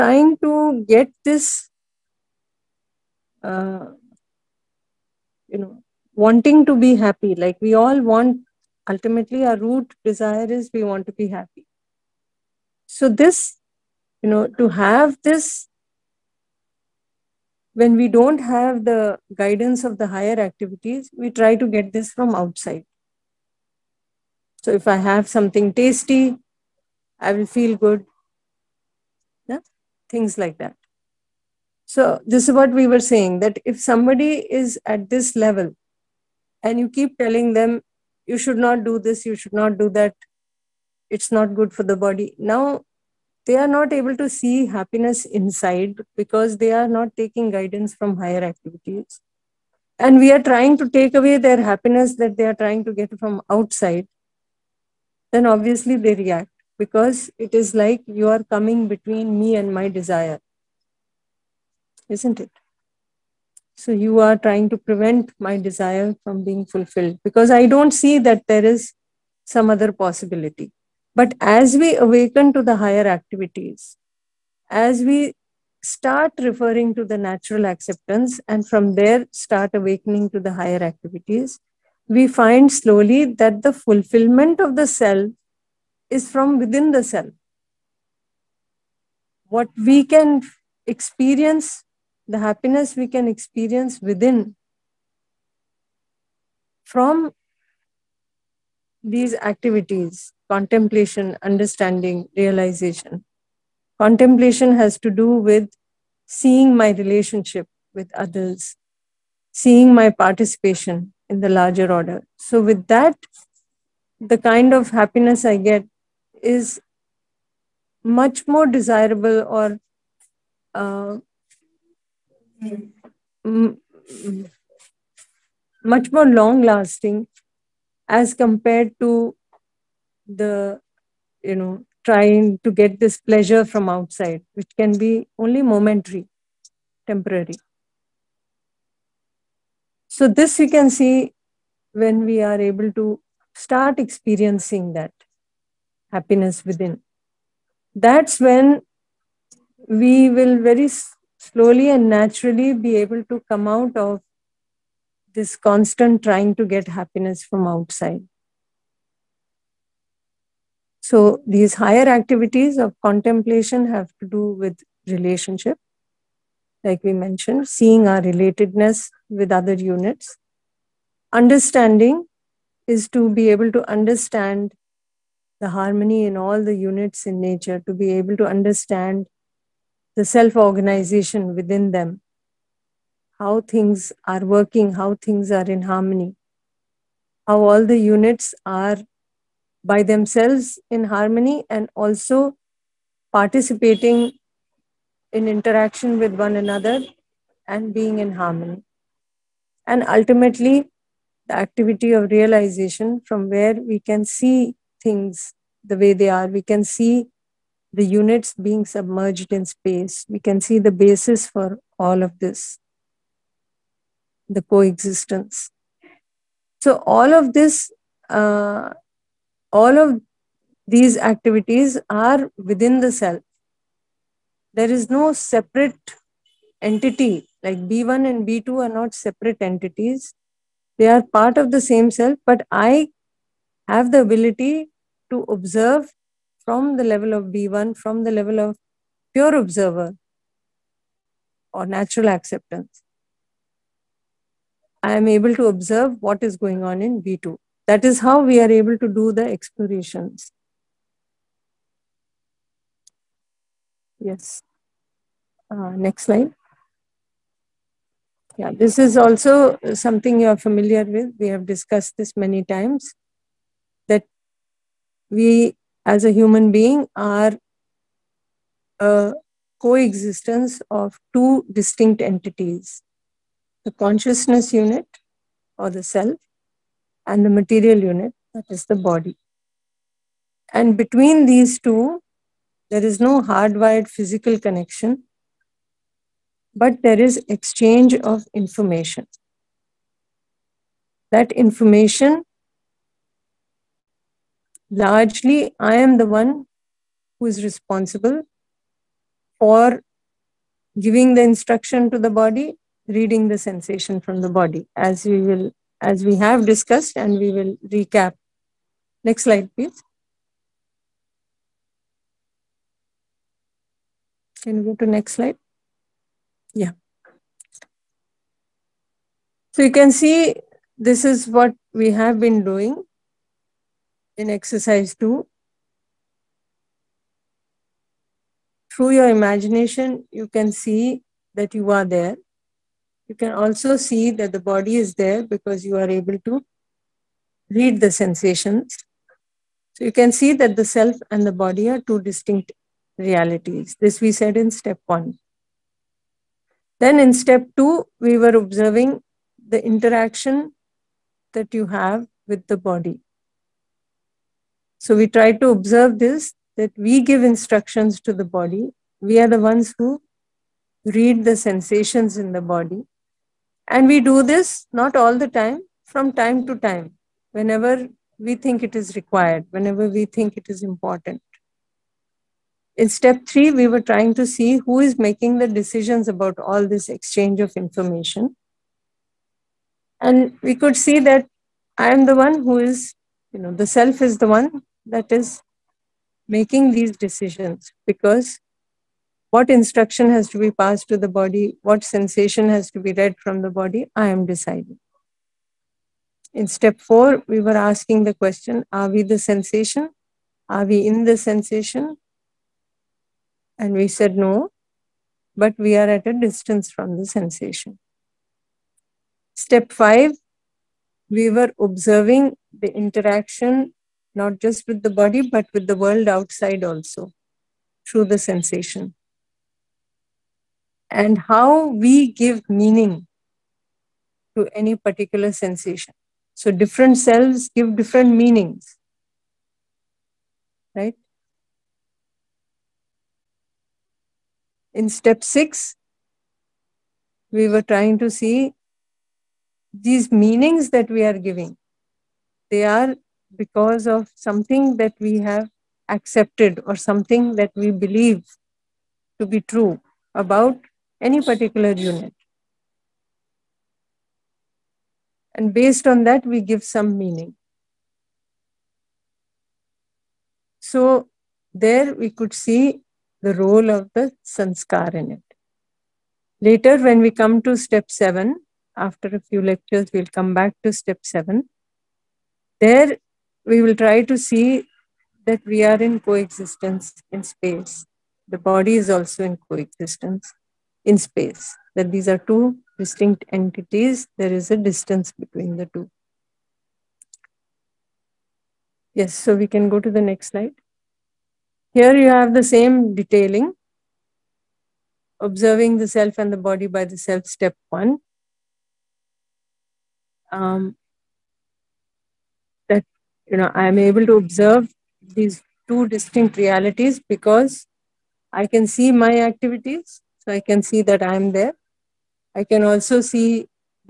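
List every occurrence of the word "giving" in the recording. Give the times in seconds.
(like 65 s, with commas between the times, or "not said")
300 s, 441 s.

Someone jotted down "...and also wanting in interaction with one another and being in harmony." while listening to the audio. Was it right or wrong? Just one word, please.
wrong.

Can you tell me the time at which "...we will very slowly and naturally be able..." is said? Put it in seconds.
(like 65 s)
149 s.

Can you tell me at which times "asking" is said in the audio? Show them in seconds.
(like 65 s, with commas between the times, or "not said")
397 s.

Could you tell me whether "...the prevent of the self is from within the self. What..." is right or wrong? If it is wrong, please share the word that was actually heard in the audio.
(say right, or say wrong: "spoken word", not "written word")
wrong: "fulfillment", not "prevent".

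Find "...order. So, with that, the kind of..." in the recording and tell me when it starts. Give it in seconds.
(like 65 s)
111 s.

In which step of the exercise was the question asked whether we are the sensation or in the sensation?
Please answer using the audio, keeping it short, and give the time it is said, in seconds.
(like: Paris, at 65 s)
Step 4, at 396 s.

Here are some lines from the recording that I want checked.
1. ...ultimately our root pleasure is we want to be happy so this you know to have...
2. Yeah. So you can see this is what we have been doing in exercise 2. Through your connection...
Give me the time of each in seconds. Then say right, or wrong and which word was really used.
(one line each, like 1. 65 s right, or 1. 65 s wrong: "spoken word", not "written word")
1. 8 s wrong: "desire", not "pleasure"
2. 316 s wrong: "imagination", not "connection".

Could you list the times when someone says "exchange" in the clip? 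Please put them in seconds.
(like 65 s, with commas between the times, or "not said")
287 s, 377 s.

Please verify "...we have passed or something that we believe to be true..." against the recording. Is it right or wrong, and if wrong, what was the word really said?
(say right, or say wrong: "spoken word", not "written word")
wrong: "accepted", not "passed".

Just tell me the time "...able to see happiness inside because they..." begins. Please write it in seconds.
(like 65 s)
43 s.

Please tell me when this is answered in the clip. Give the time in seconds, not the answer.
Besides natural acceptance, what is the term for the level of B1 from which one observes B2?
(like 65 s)
239 s.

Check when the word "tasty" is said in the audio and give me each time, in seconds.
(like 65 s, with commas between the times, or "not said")
25 s.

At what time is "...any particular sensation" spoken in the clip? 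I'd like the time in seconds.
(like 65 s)
424 s.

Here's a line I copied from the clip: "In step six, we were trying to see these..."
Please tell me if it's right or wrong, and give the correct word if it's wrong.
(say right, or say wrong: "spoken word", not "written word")
right.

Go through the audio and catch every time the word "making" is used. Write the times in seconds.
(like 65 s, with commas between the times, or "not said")
375 s, 386 s.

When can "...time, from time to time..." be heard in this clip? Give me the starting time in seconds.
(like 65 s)
365 s.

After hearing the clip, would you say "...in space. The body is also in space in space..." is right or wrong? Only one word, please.
wrong.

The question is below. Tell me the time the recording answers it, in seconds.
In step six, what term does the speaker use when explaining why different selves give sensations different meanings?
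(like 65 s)
464 s.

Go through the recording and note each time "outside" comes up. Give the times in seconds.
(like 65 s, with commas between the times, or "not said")
22 s, 53 s, 133 s, 157 s, 416 s.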